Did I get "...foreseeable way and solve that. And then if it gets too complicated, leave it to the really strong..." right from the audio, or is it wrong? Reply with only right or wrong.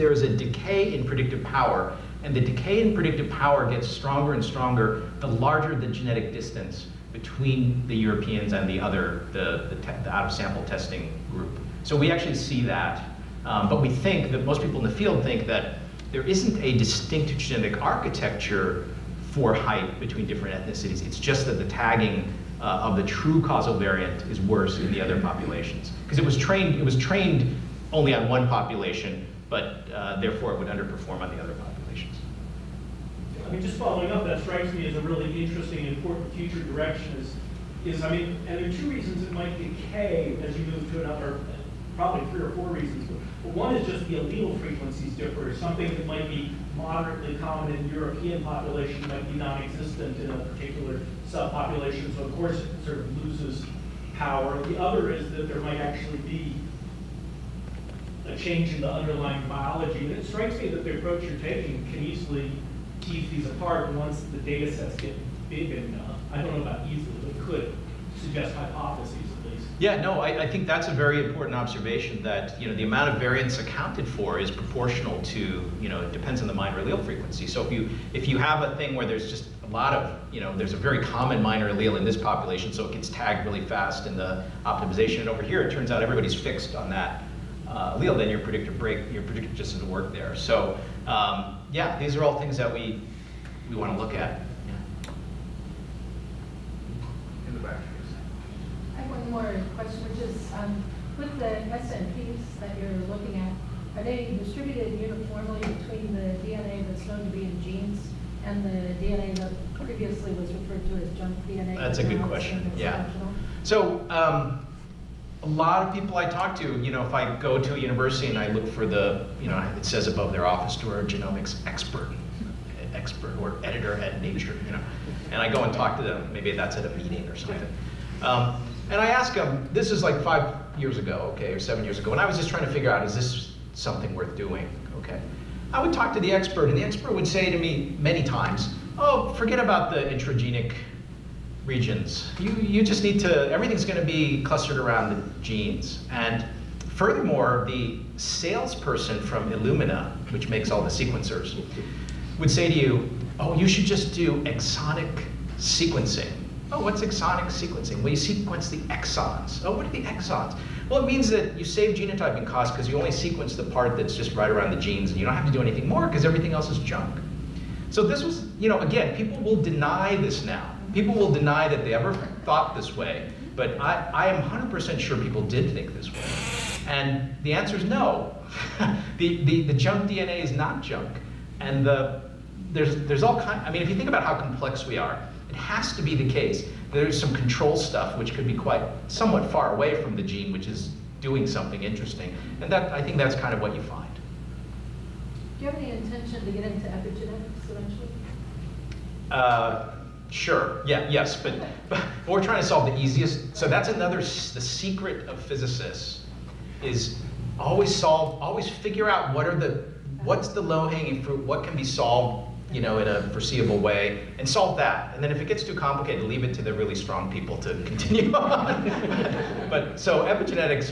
right.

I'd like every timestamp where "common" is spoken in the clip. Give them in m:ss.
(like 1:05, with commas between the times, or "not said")
0:47, 1:21.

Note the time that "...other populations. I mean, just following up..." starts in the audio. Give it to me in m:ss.
0:31.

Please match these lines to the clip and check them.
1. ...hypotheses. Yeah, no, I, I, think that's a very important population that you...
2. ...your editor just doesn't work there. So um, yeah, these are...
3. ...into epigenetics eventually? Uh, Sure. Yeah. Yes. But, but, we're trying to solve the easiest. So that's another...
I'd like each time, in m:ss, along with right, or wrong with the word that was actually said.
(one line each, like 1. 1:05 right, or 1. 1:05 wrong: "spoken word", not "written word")
1. 1:08 wrong: "observation", not "population"
2. 1:29 wrong: "predictor", not "editor"
3. 3:16 right.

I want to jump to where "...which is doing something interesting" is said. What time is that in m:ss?
3:10.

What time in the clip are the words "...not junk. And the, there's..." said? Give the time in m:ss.
3:00.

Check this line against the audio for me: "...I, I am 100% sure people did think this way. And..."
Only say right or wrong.
right.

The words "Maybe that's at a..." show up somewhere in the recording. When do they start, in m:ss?
2:06.